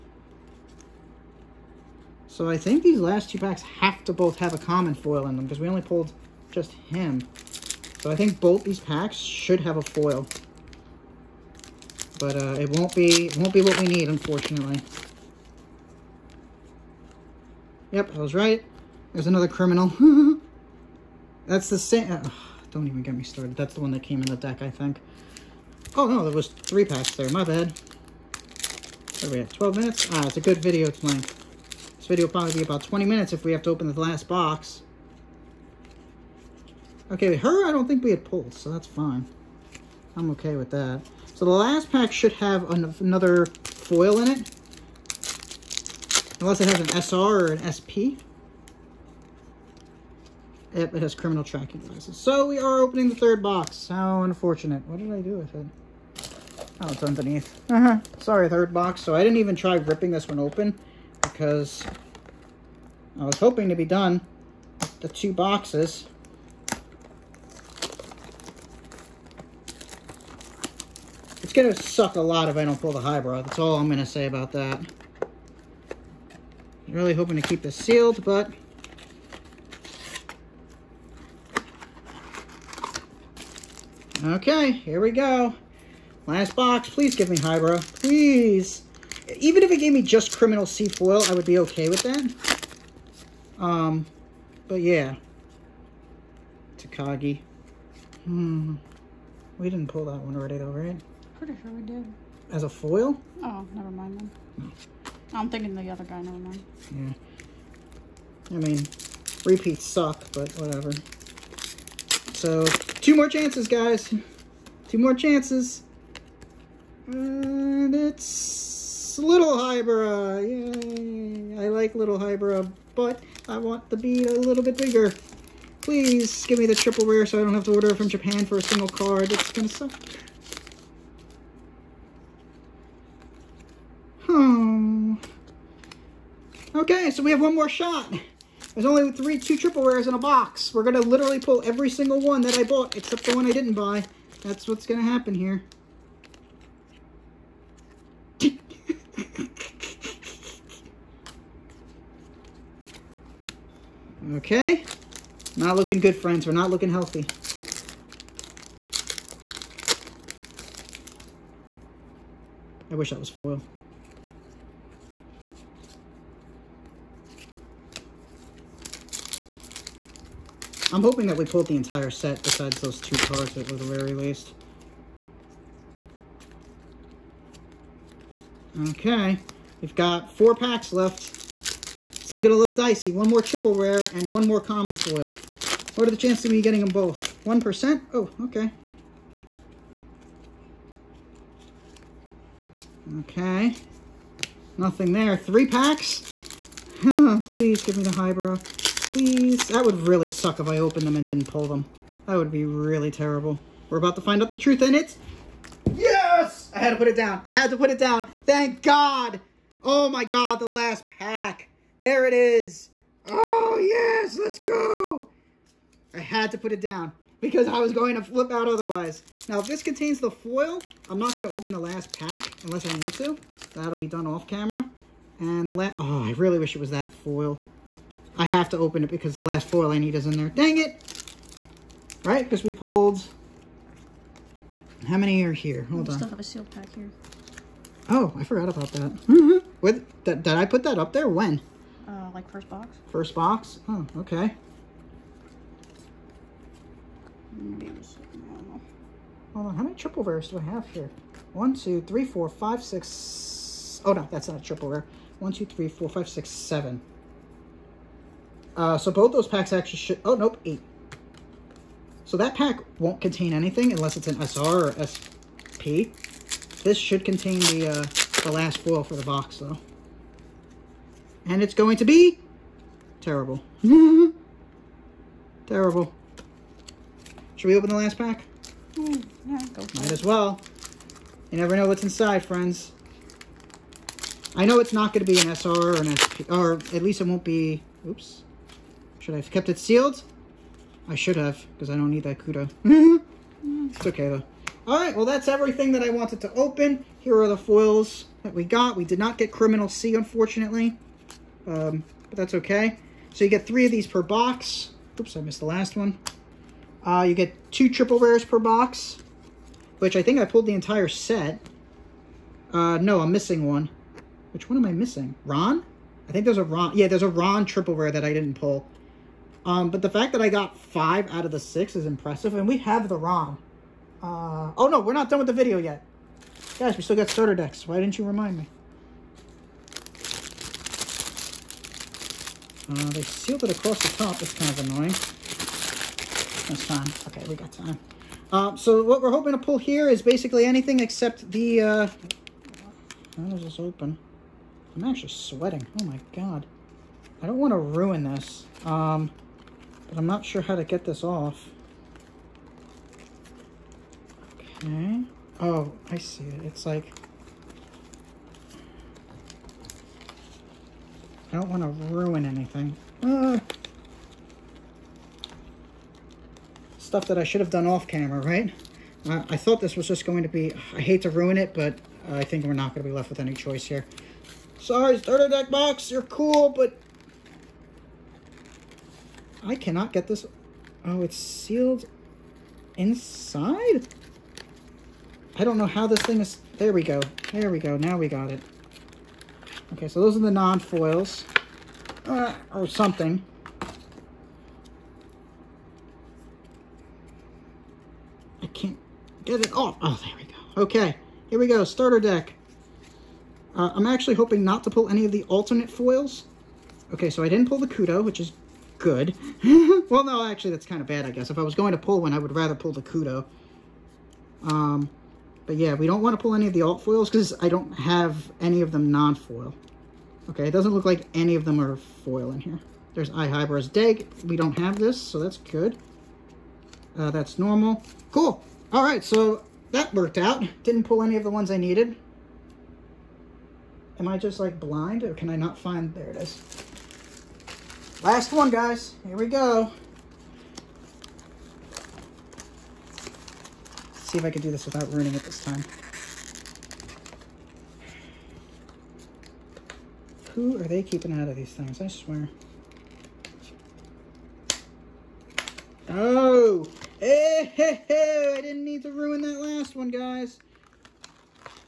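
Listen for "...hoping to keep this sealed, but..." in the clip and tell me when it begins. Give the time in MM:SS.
01:17.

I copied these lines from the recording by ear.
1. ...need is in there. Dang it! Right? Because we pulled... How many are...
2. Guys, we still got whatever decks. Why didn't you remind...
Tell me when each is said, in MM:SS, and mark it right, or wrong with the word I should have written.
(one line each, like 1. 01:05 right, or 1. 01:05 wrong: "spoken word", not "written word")
1. 03:49 right
2. 05:26 wrong: "starter", not "whatever".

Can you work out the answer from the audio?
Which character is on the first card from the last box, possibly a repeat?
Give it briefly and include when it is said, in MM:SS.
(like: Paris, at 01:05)
Takagi, at 01:36.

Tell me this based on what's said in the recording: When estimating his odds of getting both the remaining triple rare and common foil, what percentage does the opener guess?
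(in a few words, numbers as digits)
1%.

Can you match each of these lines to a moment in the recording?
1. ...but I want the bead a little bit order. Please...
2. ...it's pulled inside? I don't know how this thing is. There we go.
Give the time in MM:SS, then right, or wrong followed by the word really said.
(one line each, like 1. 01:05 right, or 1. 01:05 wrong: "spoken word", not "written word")
1. 02:02 wrong: "bigger", not "order"
2. 06:21 wrong: "sealed", not "pulled".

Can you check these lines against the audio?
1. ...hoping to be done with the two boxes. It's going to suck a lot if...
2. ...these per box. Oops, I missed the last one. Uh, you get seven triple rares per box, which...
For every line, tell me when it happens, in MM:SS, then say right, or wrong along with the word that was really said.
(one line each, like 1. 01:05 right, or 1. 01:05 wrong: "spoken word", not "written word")
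1. 01:03 right
2. 05:03 wrong: "two", not "seven".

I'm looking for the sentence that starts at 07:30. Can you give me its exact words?
Who are they keeping out of these things?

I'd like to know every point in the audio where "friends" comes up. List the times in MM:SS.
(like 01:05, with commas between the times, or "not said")
02:36, 04:42.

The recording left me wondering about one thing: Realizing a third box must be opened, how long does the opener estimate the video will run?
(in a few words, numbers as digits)
20 minutes.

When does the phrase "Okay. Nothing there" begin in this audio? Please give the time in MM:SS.
03:13.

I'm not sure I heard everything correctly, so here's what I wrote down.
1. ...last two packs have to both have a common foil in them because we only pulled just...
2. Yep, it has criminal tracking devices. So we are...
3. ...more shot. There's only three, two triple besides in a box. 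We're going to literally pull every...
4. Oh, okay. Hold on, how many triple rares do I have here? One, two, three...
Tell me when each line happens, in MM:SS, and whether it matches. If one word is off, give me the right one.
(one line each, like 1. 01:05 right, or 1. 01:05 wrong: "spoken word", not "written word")
1. 00:02 right
2. 00:50 right
3. 02:17 wrong: "rares", not "besides"
4. 04:03 right.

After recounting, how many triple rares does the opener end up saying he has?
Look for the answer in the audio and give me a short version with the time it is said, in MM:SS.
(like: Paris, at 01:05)
8, at 04:20.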